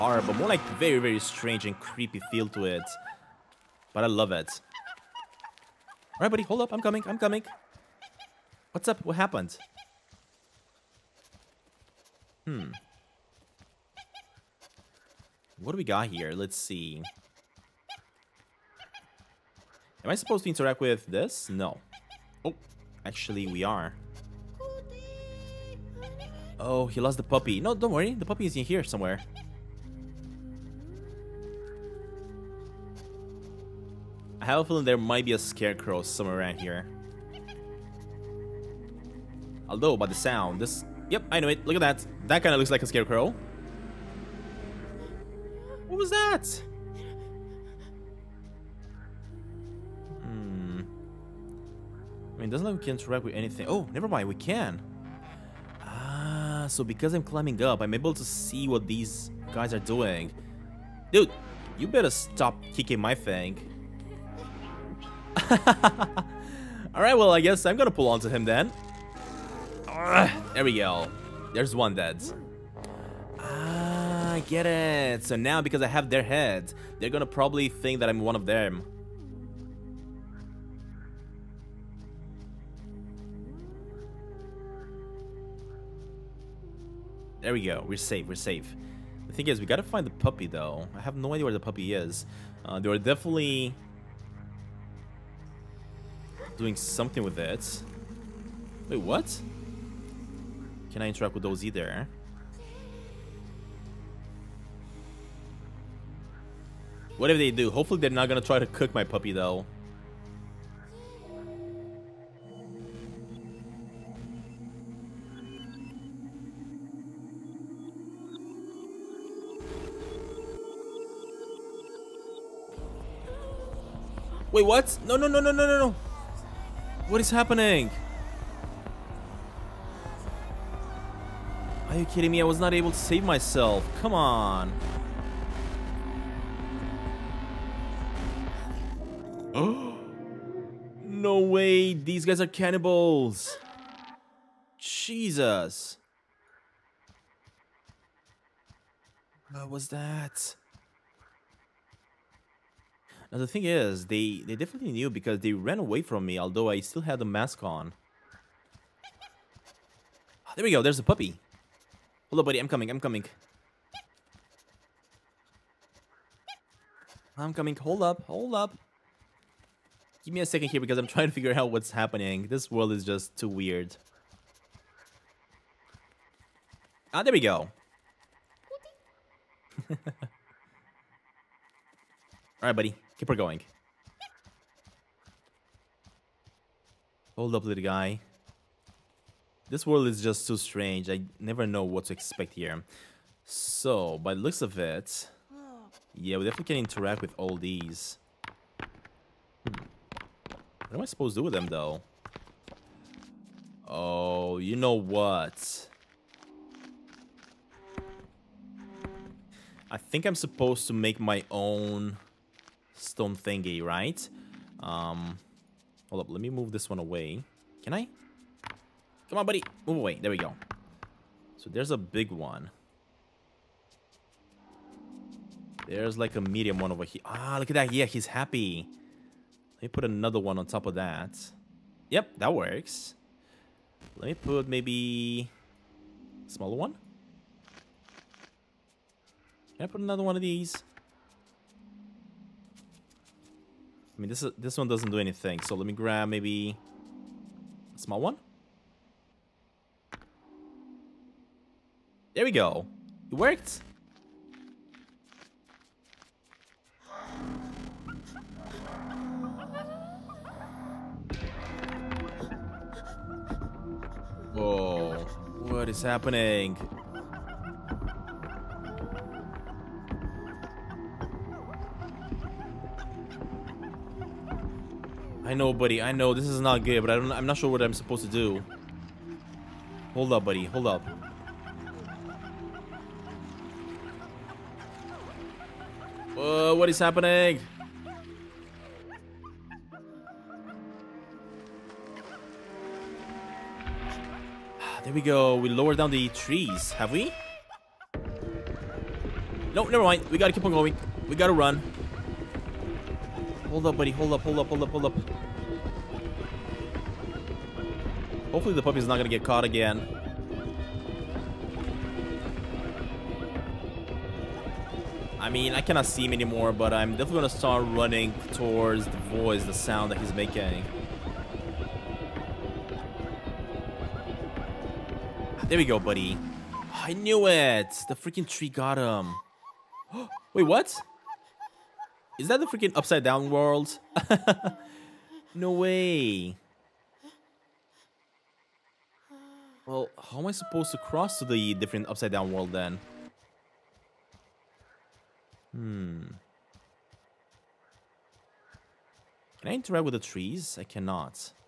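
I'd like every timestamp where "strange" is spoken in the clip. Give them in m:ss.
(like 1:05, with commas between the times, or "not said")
0:01, 3:10.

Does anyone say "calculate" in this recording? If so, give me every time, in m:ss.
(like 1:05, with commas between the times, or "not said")
not said.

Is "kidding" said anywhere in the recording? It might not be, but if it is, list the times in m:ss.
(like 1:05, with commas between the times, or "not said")
2:12.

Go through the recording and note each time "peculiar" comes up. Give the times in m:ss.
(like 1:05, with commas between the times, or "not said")
not said.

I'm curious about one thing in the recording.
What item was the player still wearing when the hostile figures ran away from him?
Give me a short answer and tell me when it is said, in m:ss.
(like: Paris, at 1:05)
The mask, at 2:37.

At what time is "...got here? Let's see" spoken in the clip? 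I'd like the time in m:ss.
0:15.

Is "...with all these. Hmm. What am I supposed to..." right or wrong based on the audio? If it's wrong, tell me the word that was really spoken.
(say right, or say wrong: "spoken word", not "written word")
right.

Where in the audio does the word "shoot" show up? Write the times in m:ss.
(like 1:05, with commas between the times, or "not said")
not said.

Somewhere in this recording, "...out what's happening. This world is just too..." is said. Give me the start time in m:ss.
2:51.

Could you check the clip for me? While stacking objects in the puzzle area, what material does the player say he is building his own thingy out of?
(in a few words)
Stone.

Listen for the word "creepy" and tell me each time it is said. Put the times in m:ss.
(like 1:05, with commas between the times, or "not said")
0:01.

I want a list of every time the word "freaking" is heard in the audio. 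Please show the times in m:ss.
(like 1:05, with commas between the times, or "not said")
5:28, 5:32.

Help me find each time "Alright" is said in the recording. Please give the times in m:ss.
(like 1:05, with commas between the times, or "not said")
1:05, 3:02.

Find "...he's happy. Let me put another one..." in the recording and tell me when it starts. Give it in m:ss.
3:48.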